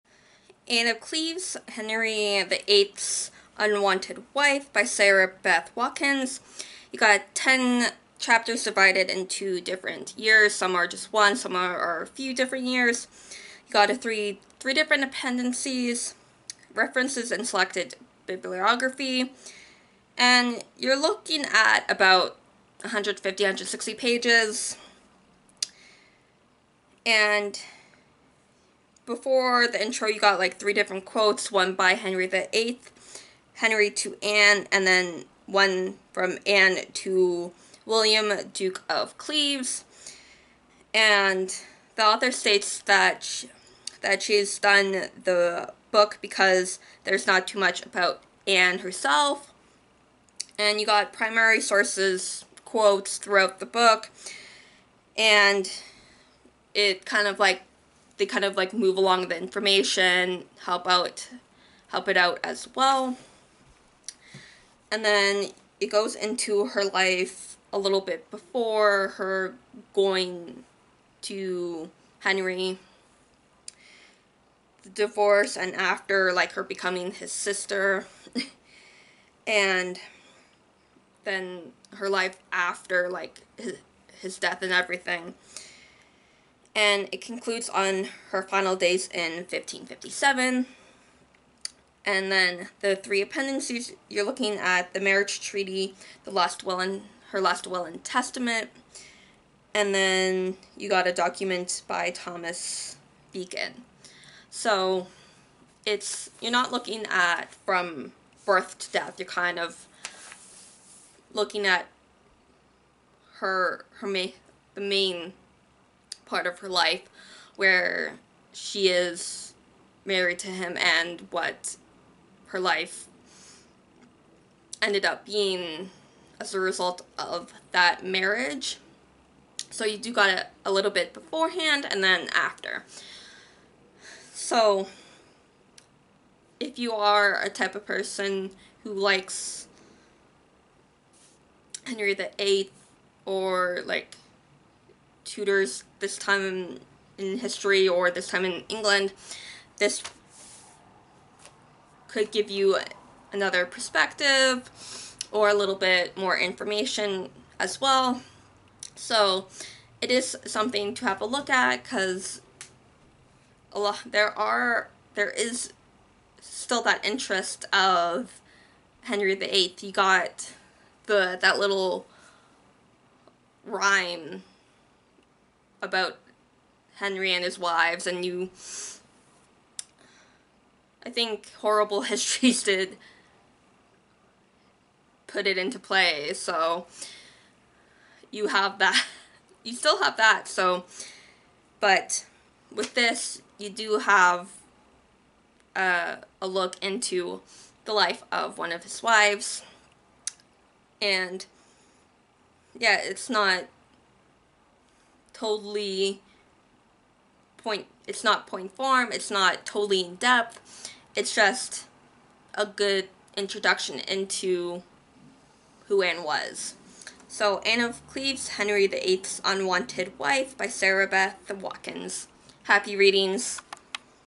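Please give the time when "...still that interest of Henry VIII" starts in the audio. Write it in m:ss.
2:46.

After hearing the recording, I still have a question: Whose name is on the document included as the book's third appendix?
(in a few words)
Thomas Beacon.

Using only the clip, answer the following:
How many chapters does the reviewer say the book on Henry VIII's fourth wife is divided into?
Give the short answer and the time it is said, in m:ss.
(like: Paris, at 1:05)
10, at 0:07.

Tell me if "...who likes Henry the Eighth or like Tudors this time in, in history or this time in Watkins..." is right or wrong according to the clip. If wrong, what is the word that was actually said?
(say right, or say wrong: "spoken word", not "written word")
wrong: "England", not "Watkins".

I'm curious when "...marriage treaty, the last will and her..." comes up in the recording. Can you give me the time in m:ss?
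1:34.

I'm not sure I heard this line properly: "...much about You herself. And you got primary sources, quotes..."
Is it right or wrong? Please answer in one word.
wrong.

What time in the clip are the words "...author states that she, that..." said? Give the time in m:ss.
0:42.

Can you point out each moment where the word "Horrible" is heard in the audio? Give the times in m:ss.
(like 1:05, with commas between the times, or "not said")
3:01.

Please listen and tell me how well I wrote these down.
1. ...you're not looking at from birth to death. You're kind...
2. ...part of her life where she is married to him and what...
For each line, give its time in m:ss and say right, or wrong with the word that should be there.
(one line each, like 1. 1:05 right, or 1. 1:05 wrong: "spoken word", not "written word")
1. 1:46 right
2. 1:56 right.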